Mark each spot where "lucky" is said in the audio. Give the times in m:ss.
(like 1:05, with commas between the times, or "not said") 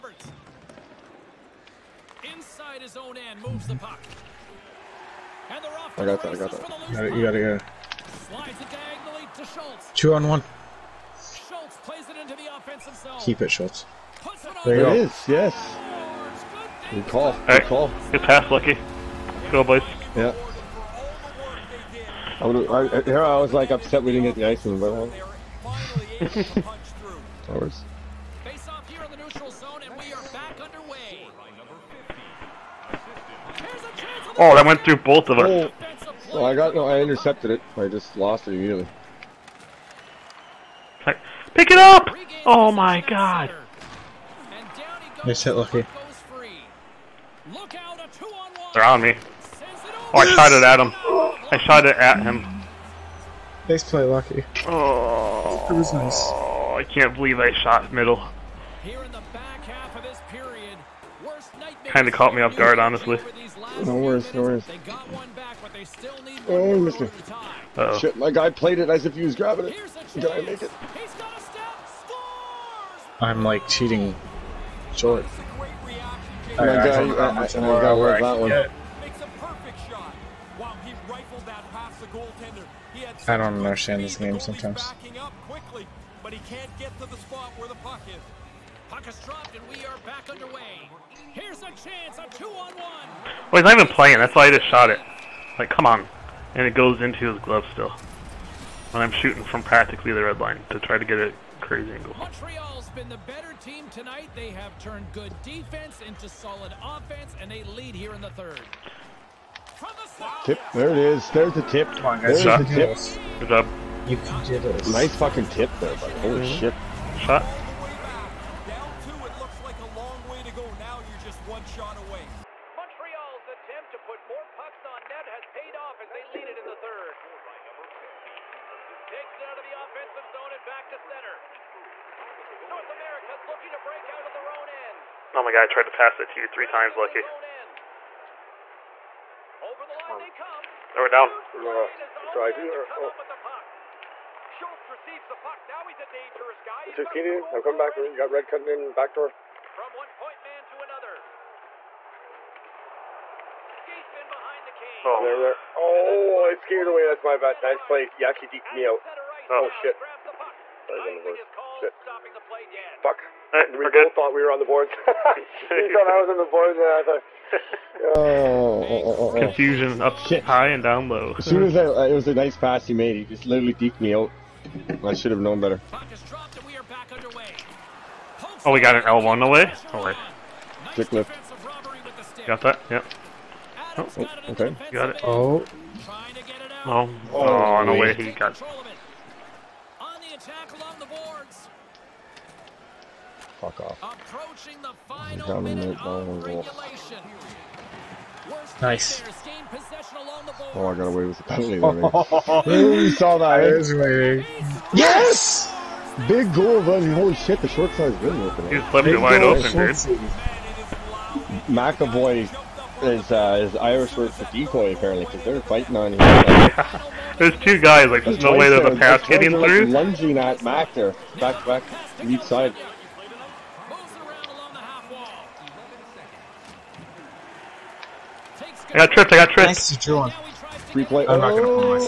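0:18, 0:45, 0:54, 2:16.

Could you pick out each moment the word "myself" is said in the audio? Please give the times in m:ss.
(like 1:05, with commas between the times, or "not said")
not said.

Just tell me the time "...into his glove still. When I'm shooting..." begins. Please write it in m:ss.
1:37.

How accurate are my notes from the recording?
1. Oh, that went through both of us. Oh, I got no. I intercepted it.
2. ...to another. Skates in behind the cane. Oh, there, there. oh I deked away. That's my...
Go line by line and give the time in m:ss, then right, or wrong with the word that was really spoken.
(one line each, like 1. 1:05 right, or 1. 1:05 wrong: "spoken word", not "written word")
1. 0:34 right
2. 2:30 wrong: "skated", not "deked".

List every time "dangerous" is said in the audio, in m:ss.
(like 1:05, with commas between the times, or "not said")
2:26.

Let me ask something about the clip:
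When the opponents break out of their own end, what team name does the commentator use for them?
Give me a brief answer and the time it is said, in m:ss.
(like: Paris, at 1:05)
North America, at 2:12.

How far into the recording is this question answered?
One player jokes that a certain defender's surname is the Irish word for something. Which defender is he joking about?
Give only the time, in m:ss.
3:31.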